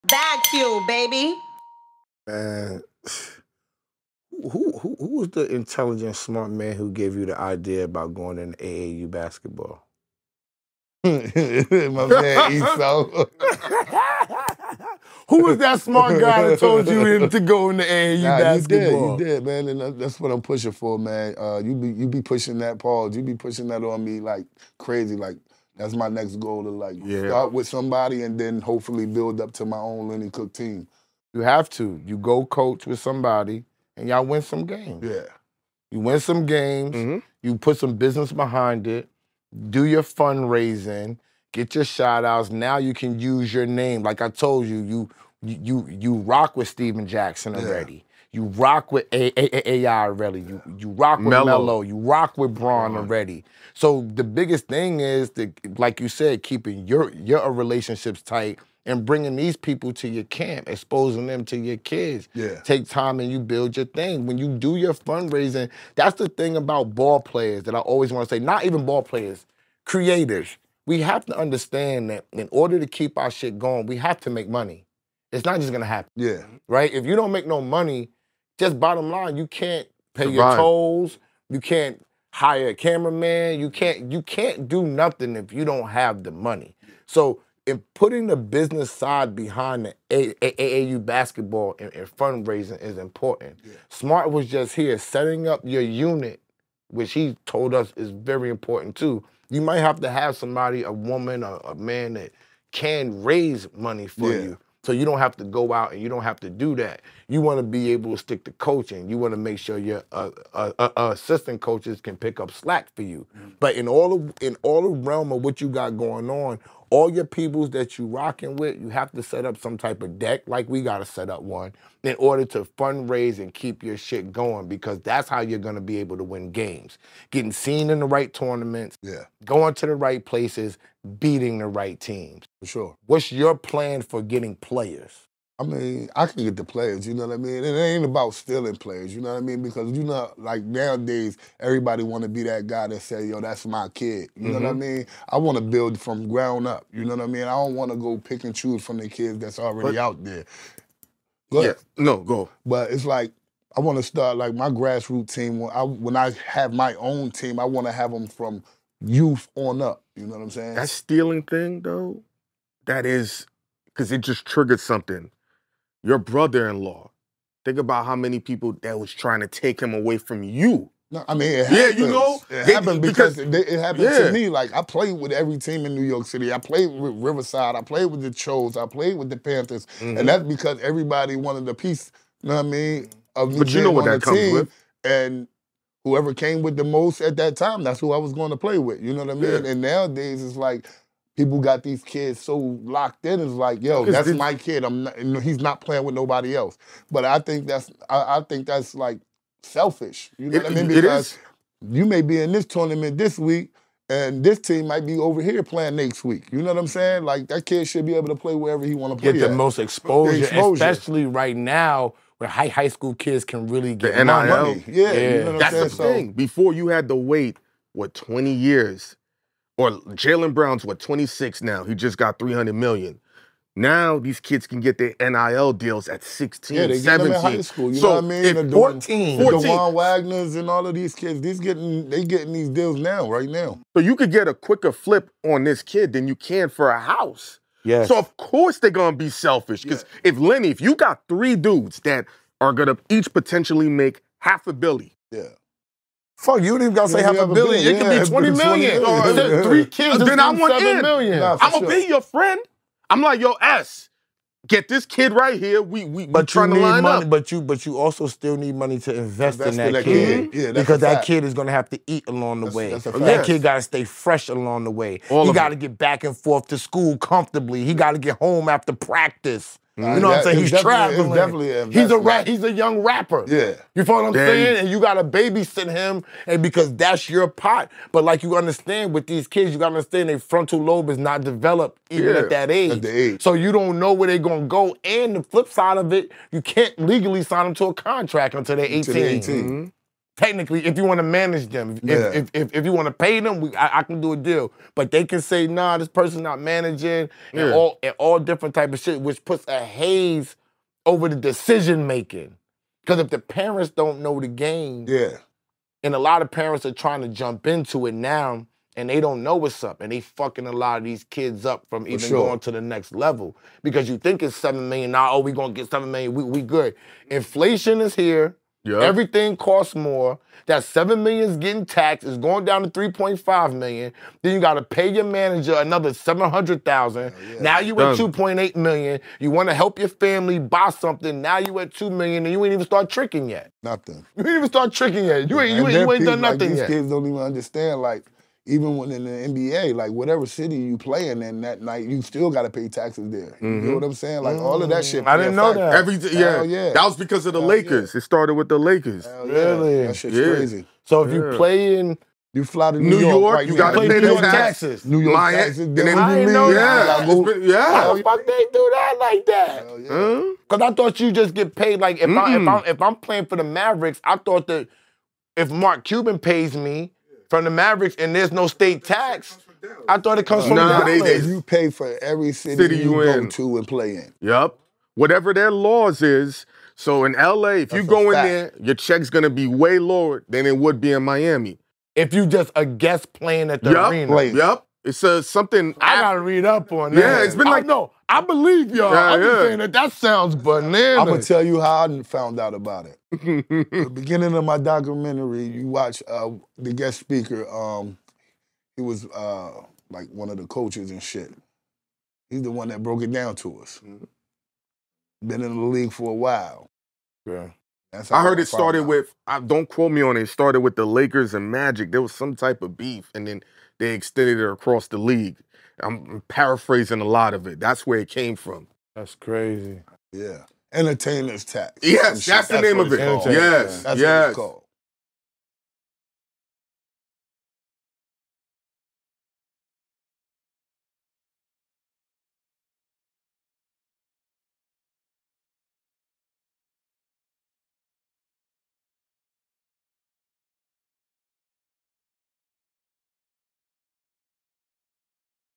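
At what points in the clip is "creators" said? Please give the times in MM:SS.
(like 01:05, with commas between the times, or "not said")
01:09.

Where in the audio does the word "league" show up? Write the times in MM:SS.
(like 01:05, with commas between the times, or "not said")
06:45, 06:55.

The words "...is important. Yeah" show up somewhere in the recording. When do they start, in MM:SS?
01:32.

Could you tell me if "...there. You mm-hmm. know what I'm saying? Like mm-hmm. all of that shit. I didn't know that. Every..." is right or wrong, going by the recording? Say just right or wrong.
right.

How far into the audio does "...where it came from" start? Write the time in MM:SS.
06:58.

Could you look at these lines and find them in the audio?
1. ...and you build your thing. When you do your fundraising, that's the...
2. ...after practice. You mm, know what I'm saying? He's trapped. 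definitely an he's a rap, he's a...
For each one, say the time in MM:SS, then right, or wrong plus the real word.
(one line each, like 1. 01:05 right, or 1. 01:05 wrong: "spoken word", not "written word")
1. 01:03 right
2. 04:28 right.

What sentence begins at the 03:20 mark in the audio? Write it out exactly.
Because you may be in this tournament this week, and this team might be over here playing next week.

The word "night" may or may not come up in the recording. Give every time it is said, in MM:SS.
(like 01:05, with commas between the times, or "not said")
05:41.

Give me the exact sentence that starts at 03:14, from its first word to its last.
I'm not, he's not playing with nobody else.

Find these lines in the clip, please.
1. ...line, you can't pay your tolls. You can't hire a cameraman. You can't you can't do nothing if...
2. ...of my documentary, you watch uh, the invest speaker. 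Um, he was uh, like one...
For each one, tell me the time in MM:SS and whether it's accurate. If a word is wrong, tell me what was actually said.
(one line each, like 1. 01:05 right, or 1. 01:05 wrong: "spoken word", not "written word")
1. 01:19 right
2. 06:34 wrong: "guest", not "invest".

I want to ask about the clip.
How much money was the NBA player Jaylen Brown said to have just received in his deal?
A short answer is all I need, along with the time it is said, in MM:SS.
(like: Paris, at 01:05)
300 million, at 03:41.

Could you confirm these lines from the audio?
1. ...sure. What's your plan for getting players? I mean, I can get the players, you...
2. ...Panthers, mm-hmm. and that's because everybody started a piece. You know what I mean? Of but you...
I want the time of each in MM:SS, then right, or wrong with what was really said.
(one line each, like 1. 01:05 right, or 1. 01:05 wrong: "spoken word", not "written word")
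1. 02:12 right
2. 02:59 wrong: "wanted", not "started".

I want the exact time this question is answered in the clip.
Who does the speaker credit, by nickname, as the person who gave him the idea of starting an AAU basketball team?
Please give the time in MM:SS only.
00:11.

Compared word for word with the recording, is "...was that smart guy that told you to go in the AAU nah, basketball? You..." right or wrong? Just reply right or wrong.
right.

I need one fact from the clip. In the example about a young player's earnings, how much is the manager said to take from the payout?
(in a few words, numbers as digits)
700,000.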